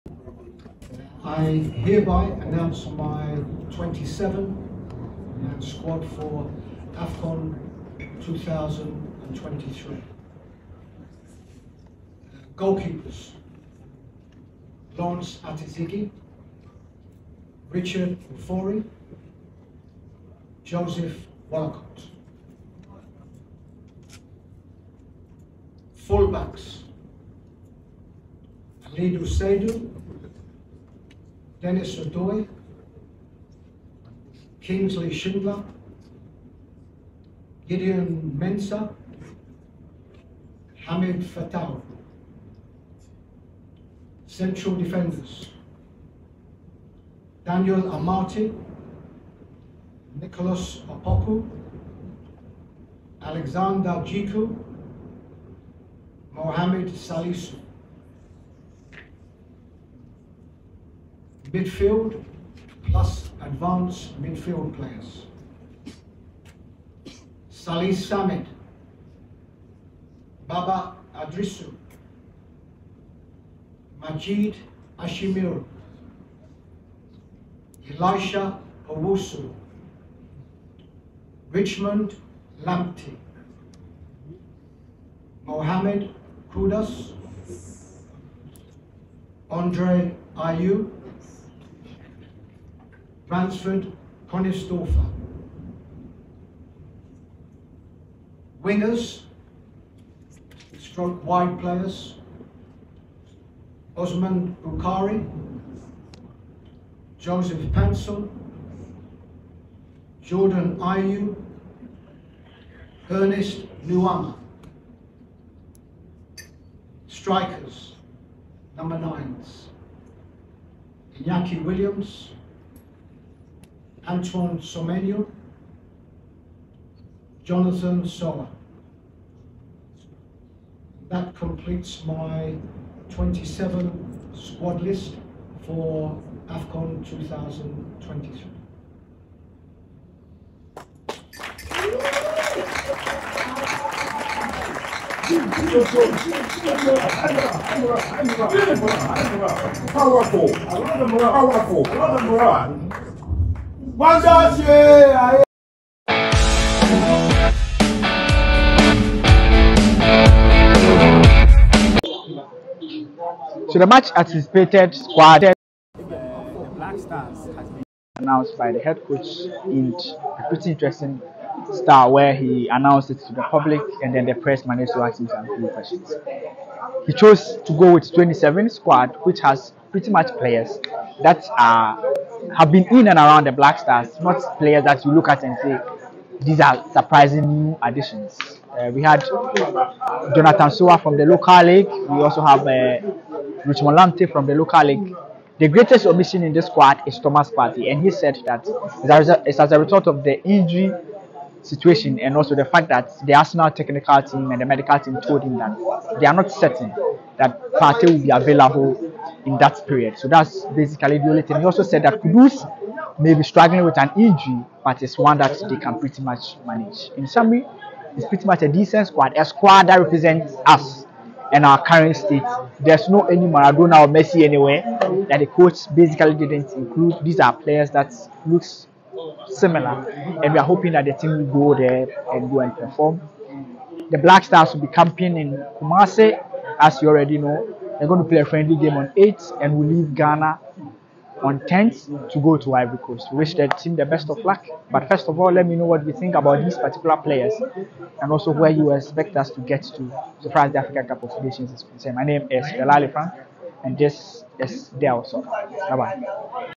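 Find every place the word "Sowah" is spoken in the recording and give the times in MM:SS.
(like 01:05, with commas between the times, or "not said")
02:08, 03:10.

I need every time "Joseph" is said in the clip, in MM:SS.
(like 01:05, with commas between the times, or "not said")
00:20, 01:47.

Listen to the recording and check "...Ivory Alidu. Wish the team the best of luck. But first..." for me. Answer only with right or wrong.
wrong.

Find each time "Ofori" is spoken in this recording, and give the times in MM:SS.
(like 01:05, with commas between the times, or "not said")
00:18.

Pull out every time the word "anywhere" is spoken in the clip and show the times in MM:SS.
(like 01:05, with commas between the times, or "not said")
03:44.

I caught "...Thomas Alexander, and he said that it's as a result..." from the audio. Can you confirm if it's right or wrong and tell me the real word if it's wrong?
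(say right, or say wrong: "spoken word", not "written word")
wrong: "Partey", not "Alexander".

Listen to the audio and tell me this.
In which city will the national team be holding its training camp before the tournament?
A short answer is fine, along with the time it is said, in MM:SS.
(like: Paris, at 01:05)
Kumasi, at 03:55.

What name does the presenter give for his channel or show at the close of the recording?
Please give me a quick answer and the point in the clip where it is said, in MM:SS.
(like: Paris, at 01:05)
DelSoka, at 04:14.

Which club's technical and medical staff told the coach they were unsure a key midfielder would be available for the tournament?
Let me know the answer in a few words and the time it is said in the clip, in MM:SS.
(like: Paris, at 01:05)
Arsenal, at 03:23.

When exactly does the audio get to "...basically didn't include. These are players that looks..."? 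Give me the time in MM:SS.
03:45.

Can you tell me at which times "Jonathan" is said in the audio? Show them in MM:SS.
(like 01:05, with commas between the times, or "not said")
02:07, 03:09.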